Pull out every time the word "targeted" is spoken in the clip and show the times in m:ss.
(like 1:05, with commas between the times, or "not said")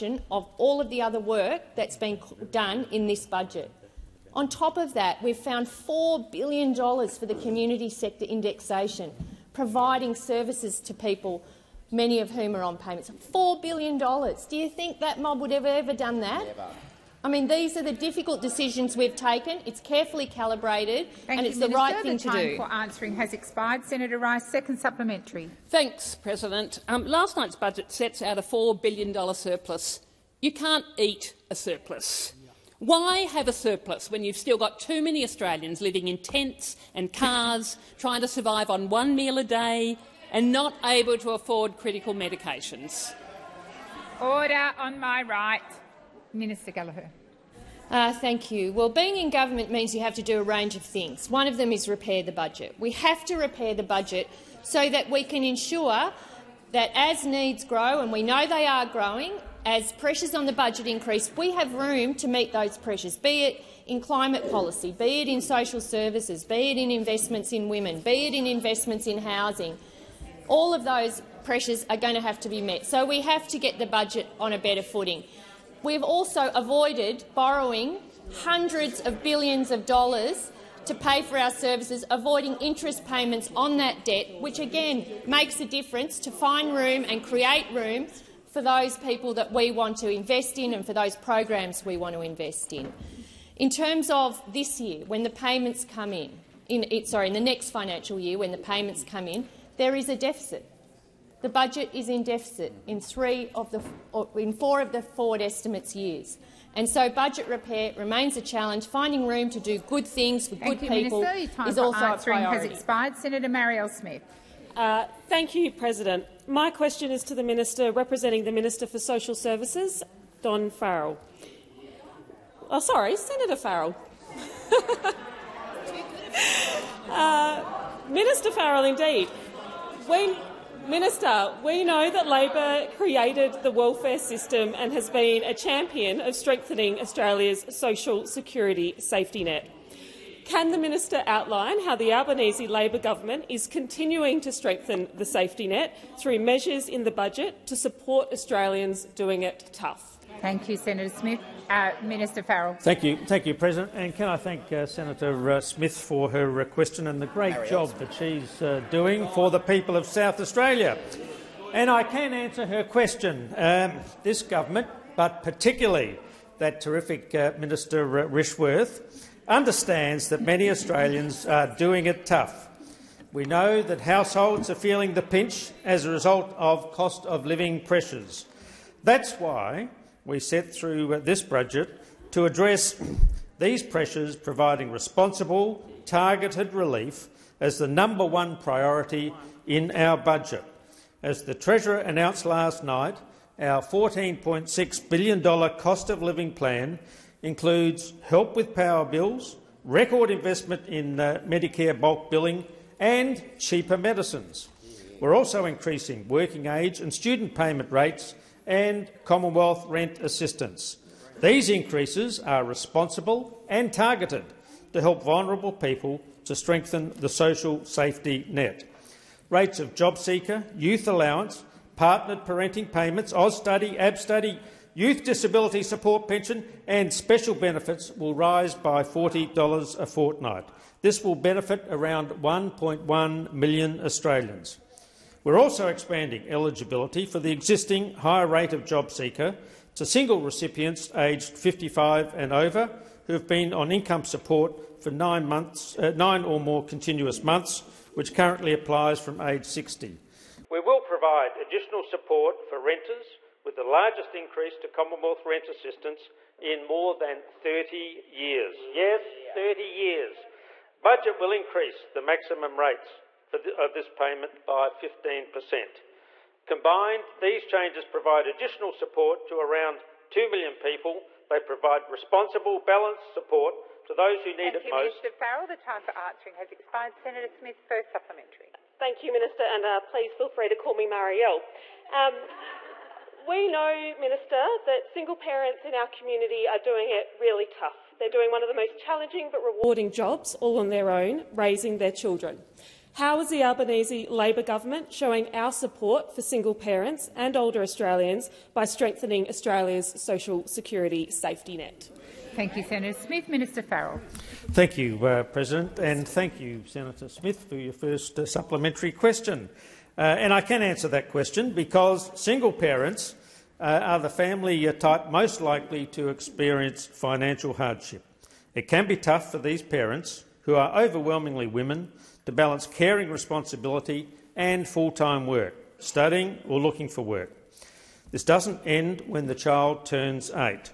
3:06, 3:33.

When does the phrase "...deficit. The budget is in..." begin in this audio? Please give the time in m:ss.
1:40.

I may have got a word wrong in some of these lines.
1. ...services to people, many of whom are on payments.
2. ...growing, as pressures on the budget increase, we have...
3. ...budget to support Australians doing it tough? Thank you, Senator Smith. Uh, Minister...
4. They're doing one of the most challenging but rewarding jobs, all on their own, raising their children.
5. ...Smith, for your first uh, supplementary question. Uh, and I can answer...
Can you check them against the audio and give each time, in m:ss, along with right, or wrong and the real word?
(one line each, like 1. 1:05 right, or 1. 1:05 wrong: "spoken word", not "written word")
1. 0:10 right
2. 0:58 right
3. 2:27 right
4. 4:48 right
5. 5:07 right.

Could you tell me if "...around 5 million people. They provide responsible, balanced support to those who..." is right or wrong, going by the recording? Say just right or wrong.
wrong.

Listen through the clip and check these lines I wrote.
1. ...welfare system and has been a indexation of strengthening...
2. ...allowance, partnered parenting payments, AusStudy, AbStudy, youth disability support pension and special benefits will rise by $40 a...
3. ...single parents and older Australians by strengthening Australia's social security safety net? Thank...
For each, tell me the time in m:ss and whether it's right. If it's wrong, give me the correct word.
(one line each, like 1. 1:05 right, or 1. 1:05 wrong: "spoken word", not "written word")
1. 2:13 wrong: "champion", not "indexation"
2. 3:41 right
3. 4:56 right.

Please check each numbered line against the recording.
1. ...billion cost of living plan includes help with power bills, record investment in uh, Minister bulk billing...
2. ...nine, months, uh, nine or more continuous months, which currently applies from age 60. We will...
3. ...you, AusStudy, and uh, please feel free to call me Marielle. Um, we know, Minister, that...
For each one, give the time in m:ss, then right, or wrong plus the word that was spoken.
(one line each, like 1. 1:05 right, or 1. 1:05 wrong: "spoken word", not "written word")
1. 3:15 wrong: "Medicare", not "Minister"
2. 4:05 right
3. 4:39 wrong: "Minister", not "AusStudy".